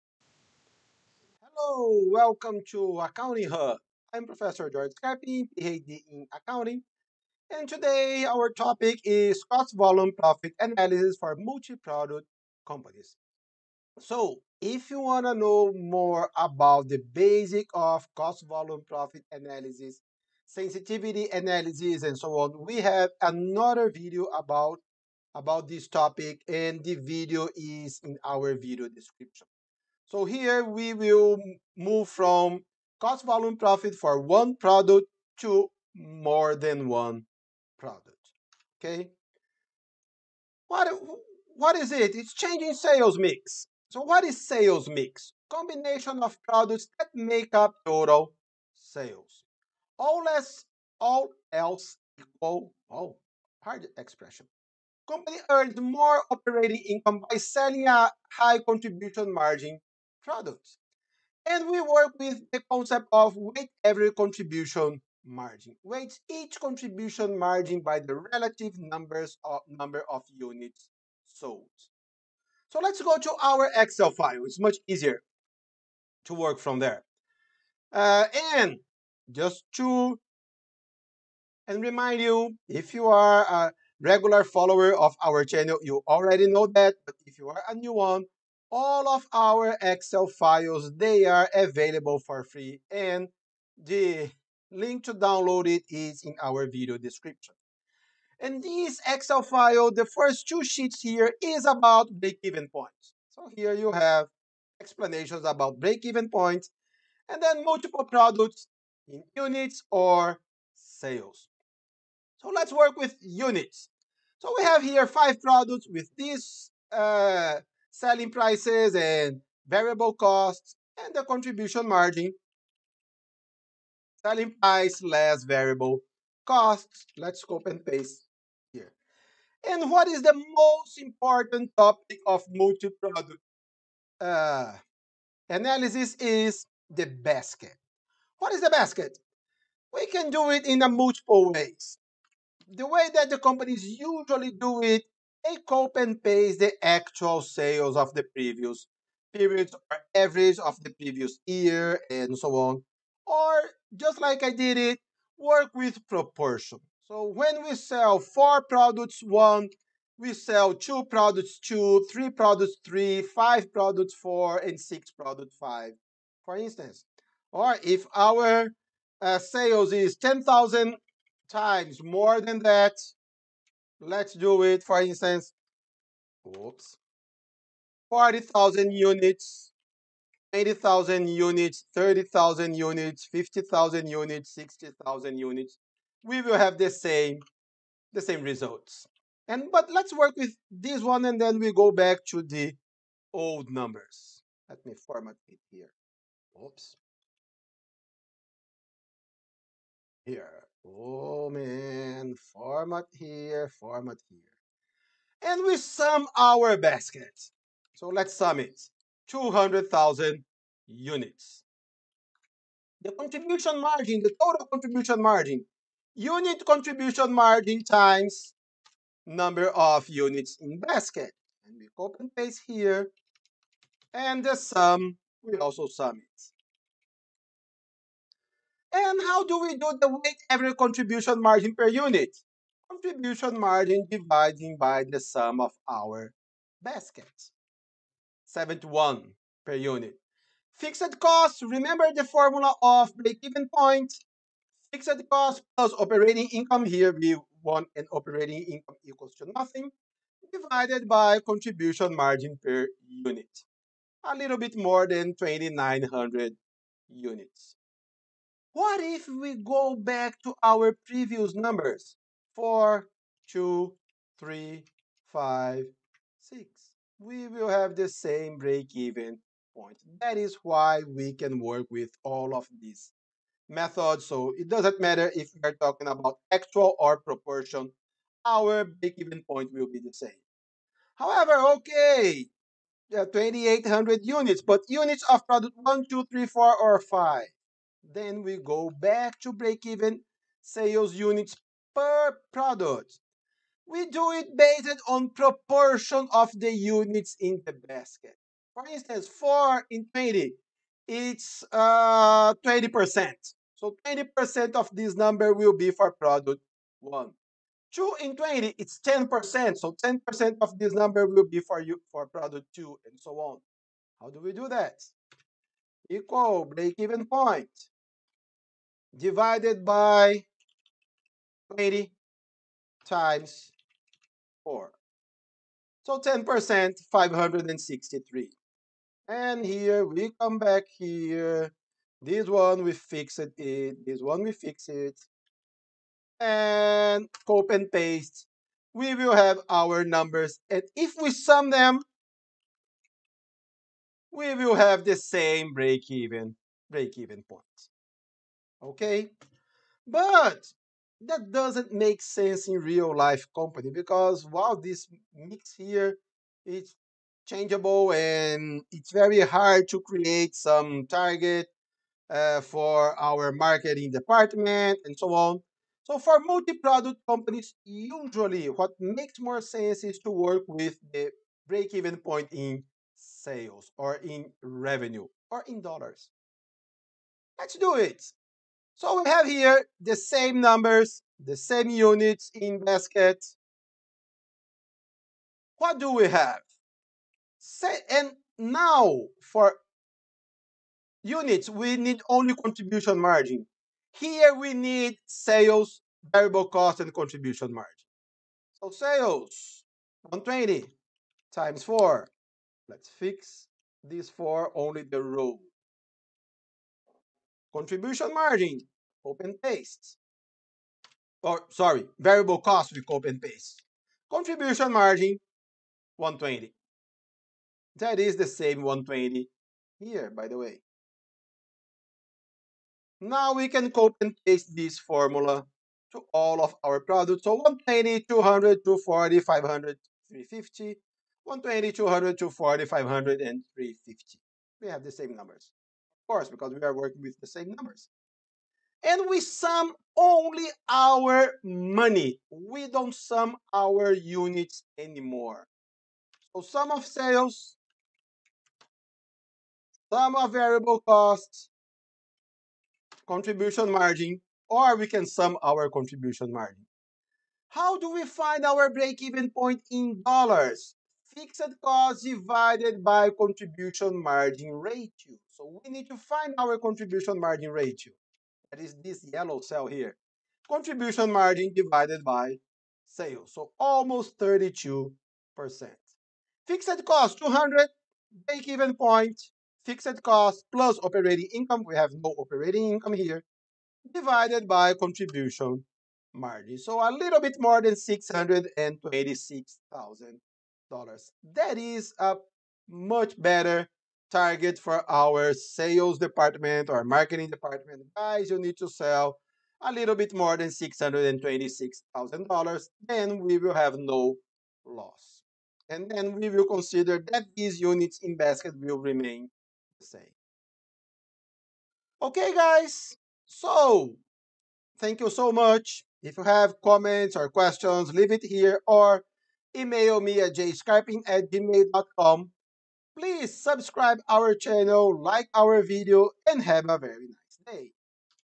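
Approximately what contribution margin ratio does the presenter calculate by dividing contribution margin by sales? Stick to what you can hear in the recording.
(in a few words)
32%.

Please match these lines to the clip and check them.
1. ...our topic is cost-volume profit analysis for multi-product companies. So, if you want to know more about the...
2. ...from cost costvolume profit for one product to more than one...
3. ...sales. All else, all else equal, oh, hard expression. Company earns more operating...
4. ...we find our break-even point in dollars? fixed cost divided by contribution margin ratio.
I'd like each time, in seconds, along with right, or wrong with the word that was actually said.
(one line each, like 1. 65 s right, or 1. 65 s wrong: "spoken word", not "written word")
1. 8 s right
2. 32 s wrong: "volume", not "costvolume"
3. 48 s right
4. 458 s right.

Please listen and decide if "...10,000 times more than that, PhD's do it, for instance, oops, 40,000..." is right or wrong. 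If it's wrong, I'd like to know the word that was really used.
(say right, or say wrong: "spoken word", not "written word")
wrong: "Let", not "PhD".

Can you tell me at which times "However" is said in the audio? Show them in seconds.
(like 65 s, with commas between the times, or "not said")
281 s.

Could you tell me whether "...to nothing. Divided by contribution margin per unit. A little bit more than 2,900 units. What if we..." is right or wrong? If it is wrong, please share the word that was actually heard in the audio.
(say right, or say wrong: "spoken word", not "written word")
right.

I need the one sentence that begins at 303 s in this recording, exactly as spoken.
So 20% of this number will be for product 1.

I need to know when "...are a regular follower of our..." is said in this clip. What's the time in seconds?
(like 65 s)
83 s.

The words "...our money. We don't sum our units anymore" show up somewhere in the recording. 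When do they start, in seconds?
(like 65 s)
440 s.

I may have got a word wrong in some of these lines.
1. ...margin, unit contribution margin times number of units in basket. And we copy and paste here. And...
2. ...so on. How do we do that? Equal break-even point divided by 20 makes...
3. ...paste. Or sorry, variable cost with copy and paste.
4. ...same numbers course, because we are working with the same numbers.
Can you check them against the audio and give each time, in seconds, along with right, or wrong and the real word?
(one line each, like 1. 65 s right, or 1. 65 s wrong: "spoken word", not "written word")
1. 215 s right
2. 313 s wrong: "times", not "makes"
3. 409 s right
4. 435 s right.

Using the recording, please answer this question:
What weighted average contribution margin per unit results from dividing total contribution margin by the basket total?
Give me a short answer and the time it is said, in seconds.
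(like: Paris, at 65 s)
71, at 238 s.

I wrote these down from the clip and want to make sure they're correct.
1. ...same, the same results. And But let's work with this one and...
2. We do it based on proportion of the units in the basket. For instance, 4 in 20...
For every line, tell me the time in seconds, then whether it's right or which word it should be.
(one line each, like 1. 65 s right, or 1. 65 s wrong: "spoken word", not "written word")
1. 186 s right
2. 293 s right.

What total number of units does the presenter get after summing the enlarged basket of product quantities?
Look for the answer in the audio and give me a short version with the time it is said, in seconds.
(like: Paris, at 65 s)
200,000, at 209 s.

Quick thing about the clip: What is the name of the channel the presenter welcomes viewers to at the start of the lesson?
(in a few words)
Accounting Hub.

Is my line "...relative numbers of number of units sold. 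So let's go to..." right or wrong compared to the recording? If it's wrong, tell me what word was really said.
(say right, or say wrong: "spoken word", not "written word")
right.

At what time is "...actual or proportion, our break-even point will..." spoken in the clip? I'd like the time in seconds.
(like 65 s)
276 s.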